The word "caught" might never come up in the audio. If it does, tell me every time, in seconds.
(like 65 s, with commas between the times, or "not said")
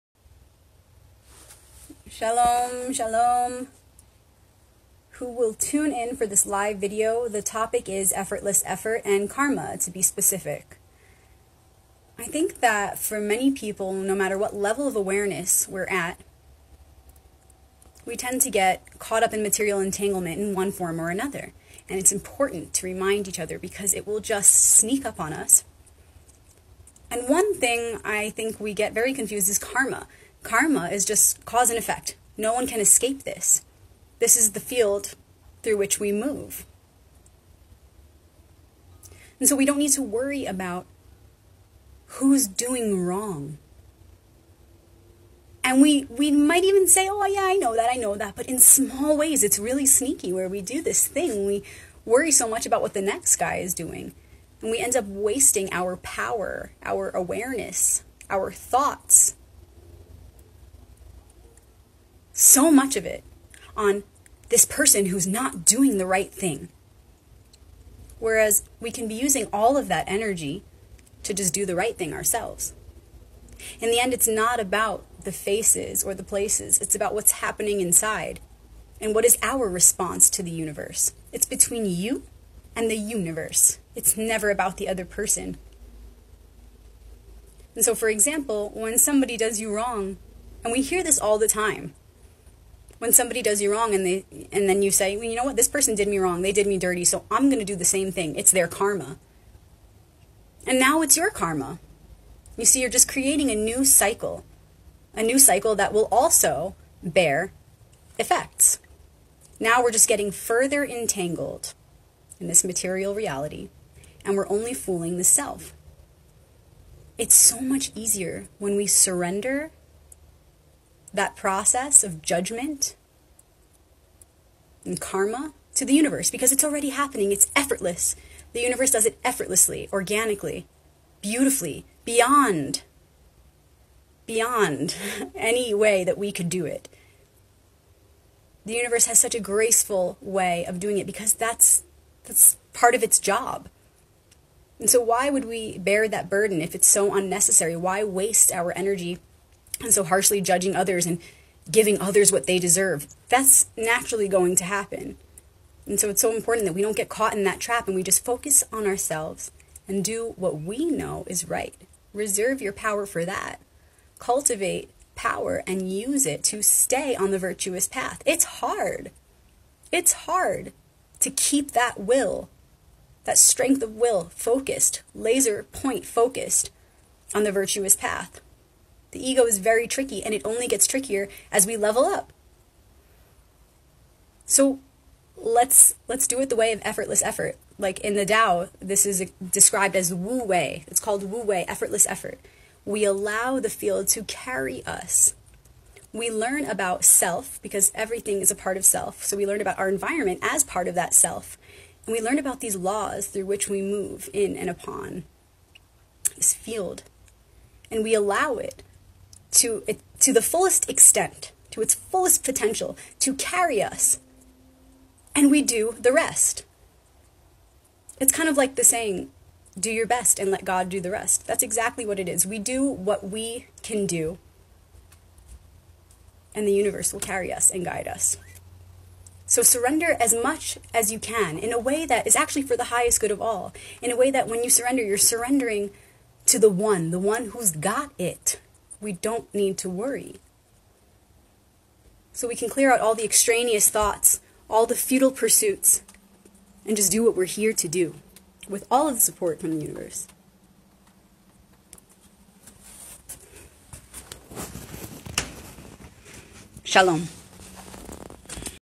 18 s, 157 s.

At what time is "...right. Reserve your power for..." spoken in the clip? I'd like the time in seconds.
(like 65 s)
161 s.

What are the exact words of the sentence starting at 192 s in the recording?
We allow the field to carry us.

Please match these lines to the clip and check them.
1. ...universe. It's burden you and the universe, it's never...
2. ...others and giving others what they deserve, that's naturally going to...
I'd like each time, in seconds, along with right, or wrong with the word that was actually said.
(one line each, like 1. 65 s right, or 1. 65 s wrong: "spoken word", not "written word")
1. 80 s wrong: "between", not "burden"
2. 150 s right.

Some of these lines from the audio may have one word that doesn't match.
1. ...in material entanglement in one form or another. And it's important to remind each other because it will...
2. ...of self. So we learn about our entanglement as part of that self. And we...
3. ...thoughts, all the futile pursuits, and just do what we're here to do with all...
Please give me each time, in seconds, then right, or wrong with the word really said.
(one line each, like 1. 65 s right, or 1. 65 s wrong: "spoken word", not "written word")
1. 19 s right
2. 198 s wrong: "environment", not "entanglement"
3. 243 s right.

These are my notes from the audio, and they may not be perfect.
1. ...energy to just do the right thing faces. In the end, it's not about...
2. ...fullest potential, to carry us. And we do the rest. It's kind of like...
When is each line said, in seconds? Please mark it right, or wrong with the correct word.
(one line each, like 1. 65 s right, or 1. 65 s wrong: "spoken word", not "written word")
1. 70 s wrong: "ourselves", not "faces"
2. 211 s right.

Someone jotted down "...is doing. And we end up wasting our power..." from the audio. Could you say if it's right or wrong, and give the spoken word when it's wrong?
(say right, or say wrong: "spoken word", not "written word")
right.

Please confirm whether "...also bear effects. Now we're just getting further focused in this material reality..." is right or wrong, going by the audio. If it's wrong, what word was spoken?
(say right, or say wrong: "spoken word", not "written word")
wrong: "entangled", not "focused".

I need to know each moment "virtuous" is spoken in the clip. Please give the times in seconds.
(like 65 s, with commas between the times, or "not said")
167 s, 177 s.